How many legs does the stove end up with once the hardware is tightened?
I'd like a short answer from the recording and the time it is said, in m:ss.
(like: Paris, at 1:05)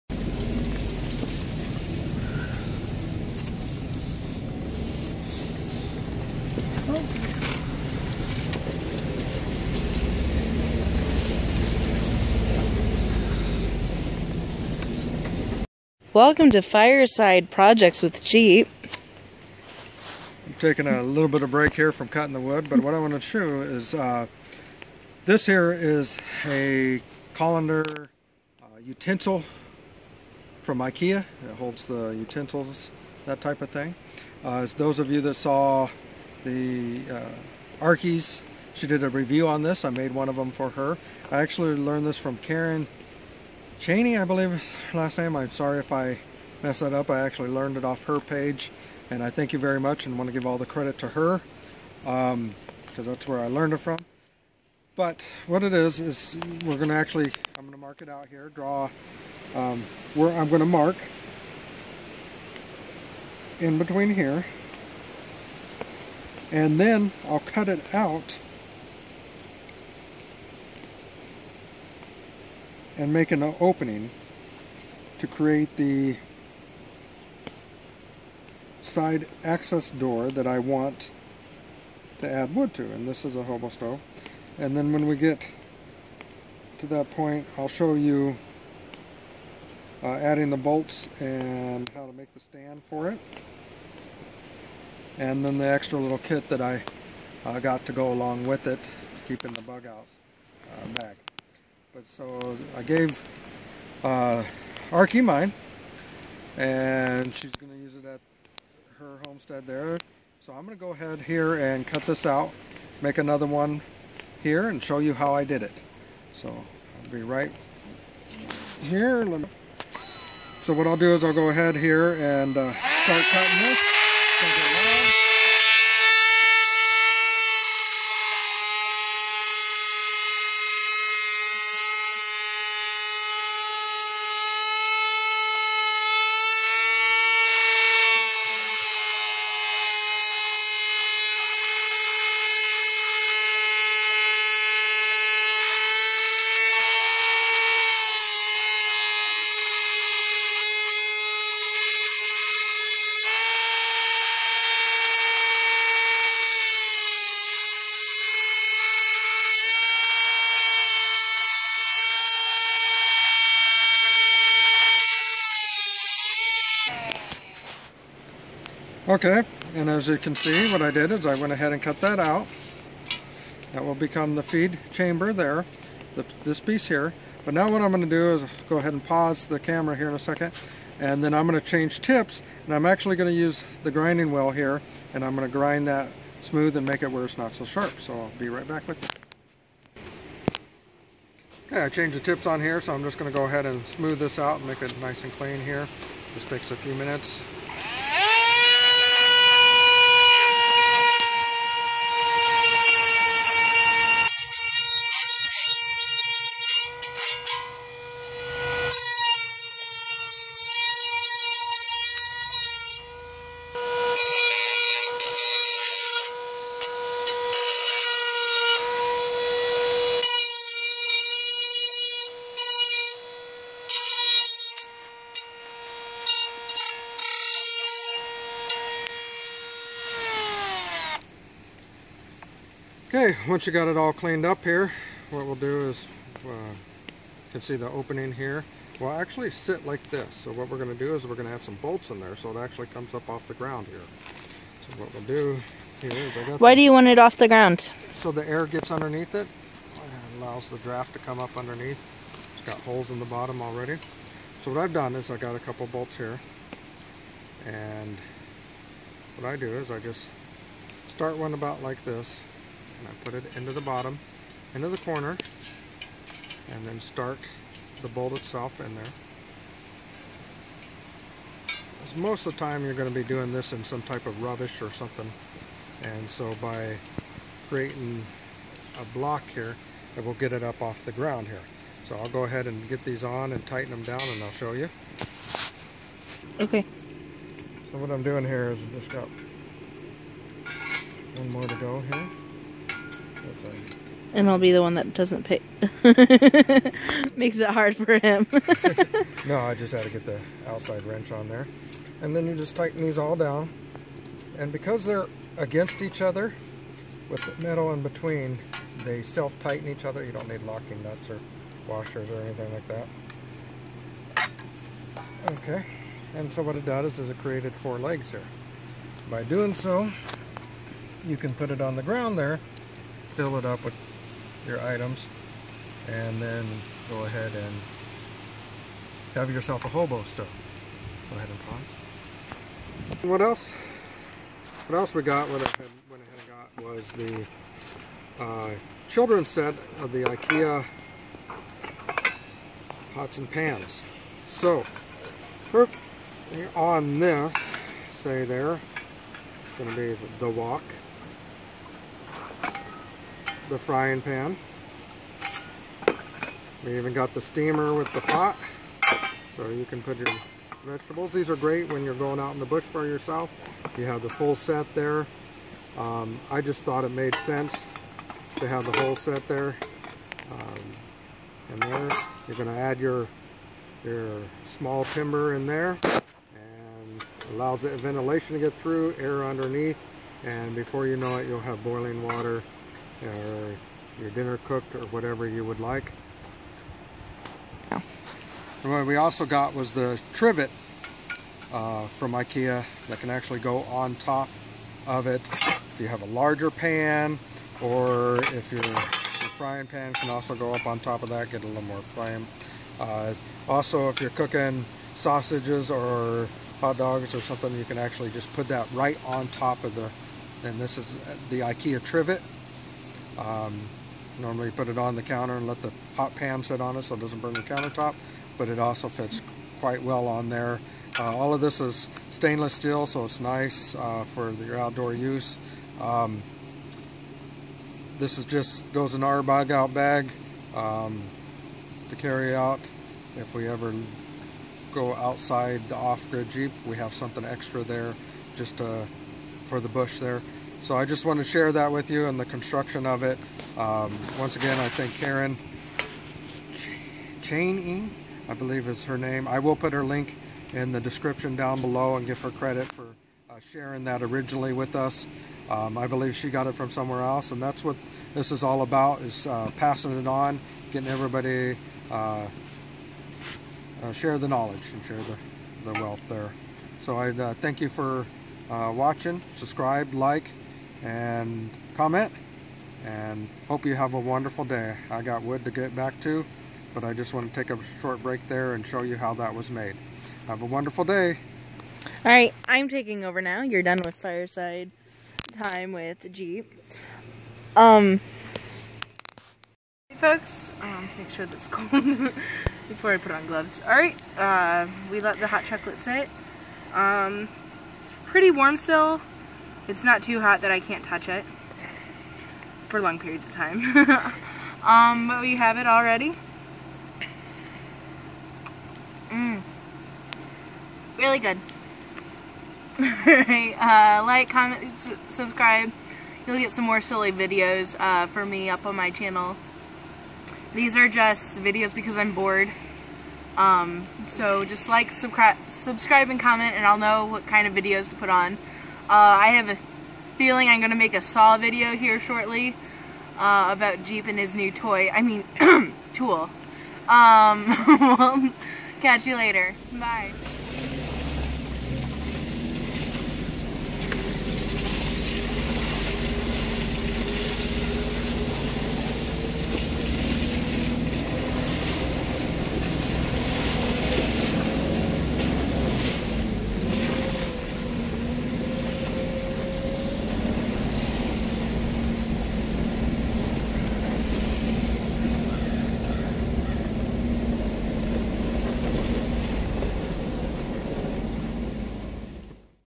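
4, at 5:17.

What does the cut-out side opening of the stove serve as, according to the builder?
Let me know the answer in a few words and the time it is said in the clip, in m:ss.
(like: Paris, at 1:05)
feed chamber, at 2:54.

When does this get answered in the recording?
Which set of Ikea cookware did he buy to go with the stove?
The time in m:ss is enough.
5:39.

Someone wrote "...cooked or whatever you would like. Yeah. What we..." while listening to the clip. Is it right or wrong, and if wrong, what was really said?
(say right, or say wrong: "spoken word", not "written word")
right.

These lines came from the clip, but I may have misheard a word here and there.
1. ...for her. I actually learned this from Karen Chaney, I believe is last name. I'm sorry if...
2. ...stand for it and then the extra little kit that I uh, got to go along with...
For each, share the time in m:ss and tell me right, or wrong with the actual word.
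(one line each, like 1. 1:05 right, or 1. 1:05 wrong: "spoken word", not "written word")
1. 0:40 wrong: "Cheney", not "Chaney"
2. 1:32 right.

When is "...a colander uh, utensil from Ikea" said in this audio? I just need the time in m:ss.
0:26.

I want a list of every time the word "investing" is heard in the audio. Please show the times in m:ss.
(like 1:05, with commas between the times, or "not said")
not said.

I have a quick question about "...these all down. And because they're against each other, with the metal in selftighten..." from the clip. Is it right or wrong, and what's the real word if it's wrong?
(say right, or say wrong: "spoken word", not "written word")
wrong: "between", not "selftighten".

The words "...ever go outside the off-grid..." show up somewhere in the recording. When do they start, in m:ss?
7:13.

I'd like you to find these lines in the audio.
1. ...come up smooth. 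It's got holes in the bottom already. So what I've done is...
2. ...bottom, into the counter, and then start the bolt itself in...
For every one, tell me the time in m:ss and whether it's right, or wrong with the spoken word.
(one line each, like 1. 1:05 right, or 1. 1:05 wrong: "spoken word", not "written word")
1. 4:11 wrong: "underneath", not "smooth"
2. 4:23 wrong: "corner", not "counter".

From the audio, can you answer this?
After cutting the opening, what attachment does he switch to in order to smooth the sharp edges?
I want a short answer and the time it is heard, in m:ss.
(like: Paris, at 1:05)
grinding wheel, at 3:03.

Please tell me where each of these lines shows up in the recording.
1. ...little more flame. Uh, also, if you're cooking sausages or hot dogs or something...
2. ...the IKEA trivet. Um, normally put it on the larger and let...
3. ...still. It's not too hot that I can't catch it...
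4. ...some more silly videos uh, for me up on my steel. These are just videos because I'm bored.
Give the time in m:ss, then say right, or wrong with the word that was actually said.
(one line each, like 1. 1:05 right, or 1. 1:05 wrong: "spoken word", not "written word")
1. 6:41 right
2. 6:51 wrong: "counter", not "larger"
3. 8:18 wrong: "touch", not "catch"
4. 8:36 wrong: "channel", not "steel".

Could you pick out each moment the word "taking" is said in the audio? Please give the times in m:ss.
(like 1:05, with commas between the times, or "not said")
0:20, 8:02.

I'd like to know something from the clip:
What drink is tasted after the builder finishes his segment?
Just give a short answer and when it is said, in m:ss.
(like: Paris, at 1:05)
hot chocolate, at 8:15.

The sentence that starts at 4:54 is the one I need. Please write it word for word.
And I'll be the one that doesn't pick.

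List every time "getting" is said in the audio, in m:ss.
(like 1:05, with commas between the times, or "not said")
7:40.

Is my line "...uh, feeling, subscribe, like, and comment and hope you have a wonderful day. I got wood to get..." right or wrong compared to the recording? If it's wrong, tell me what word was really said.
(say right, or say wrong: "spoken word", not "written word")
wrong: "watching", not "feeling".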